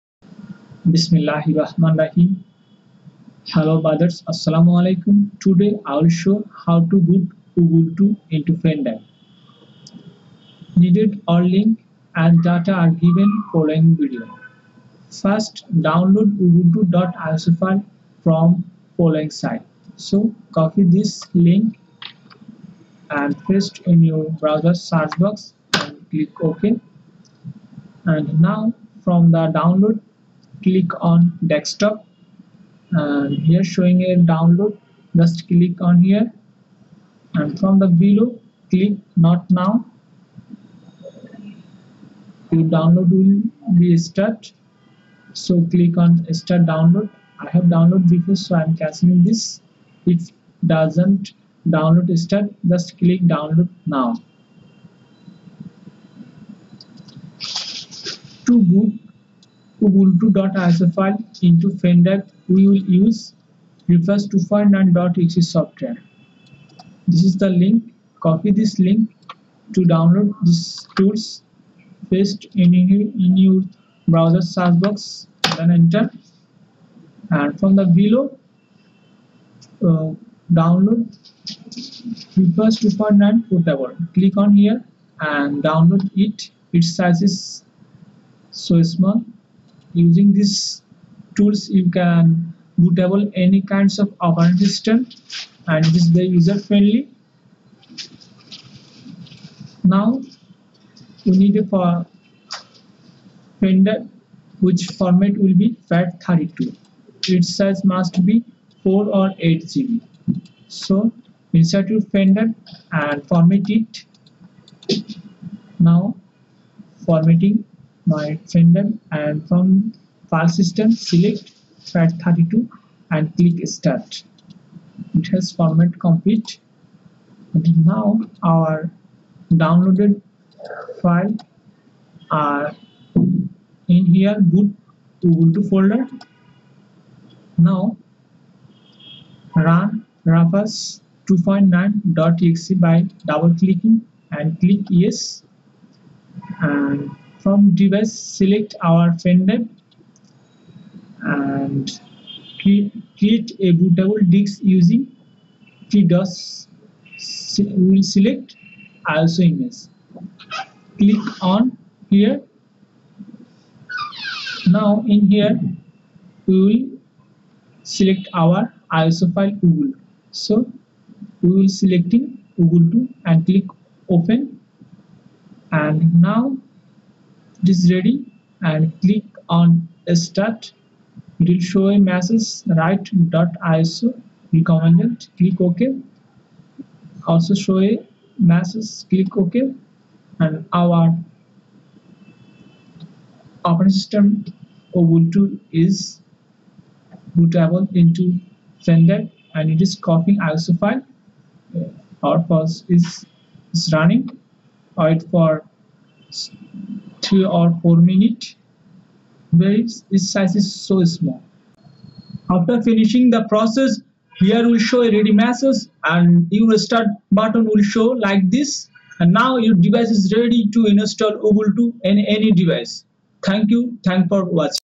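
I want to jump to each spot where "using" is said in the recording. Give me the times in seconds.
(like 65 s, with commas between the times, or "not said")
89 s, 154 s.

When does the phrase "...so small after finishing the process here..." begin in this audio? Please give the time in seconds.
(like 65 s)
210 s.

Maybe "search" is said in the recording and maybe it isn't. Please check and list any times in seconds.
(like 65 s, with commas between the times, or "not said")
24 s, 74 s.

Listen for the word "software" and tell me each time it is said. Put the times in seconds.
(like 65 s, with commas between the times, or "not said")
65 s.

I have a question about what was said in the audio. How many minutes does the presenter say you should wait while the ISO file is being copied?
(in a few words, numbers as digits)
3 or 4 minutes.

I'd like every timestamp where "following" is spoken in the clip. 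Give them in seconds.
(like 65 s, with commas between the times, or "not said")
13 s, 18 s.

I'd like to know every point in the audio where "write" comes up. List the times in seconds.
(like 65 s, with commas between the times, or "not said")
182 s.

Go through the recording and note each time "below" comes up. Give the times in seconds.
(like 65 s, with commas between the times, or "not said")
38 s, 77 s.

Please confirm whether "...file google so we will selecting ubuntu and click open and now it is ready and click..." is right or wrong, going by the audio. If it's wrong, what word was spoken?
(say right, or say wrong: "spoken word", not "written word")
right.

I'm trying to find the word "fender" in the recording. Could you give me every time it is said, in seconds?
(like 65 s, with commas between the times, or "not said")
8 s, 61 s, 112 s, 118 s, 149 s, 198 s.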